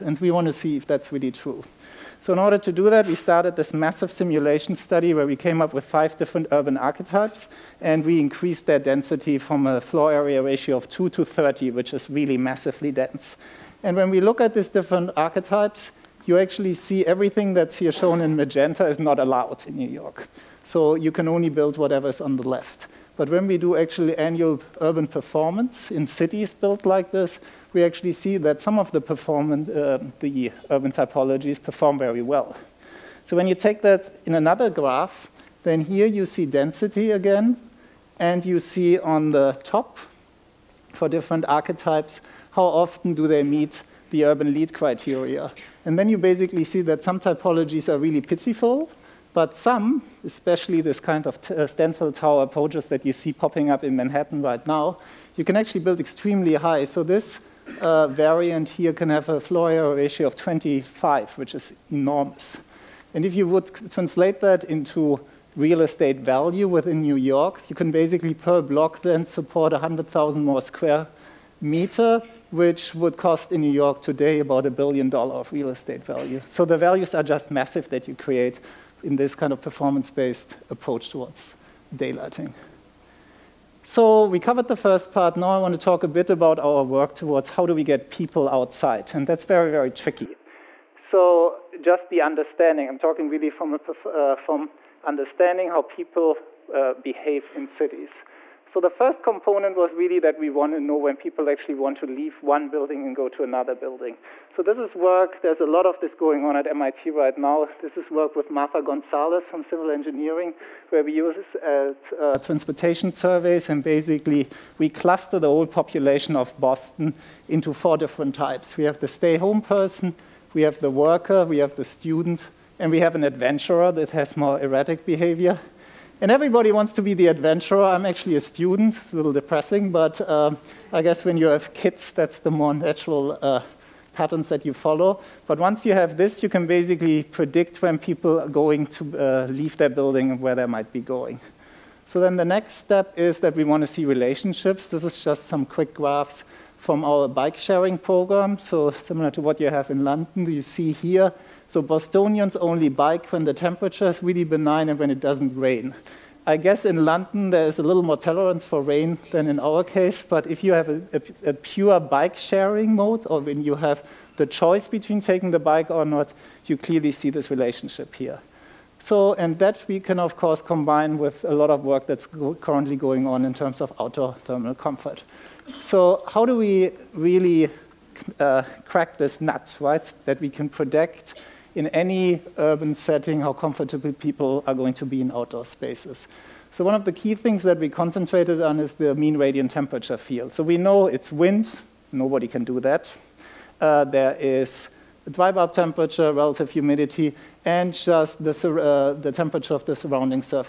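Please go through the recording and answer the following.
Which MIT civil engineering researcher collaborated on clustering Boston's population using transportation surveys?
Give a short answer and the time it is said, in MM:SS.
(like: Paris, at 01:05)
Marta Gonzalez, at 01:48.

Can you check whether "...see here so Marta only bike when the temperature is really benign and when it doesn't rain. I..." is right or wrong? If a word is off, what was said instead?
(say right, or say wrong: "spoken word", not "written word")
wrong: "Bostonians", not "Marta".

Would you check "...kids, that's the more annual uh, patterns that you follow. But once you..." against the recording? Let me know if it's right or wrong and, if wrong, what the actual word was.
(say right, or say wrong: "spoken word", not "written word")
wrong: "natural", not "annual".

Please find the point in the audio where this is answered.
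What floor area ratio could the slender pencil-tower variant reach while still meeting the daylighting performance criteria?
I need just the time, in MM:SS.
01:00.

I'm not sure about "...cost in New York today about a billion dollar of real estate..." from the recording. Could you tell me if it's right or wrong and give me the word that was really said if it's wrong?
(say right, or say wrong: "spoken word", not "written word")
right.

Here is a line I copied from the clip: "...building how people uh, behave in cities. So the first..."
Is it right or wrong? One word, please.
wrong.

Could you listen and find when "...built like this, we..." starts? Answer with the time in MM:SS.
00:26.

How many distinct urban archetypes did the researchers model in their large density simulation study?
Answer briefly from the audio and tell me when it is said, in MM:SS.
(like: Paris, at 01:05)
5, at 00:05.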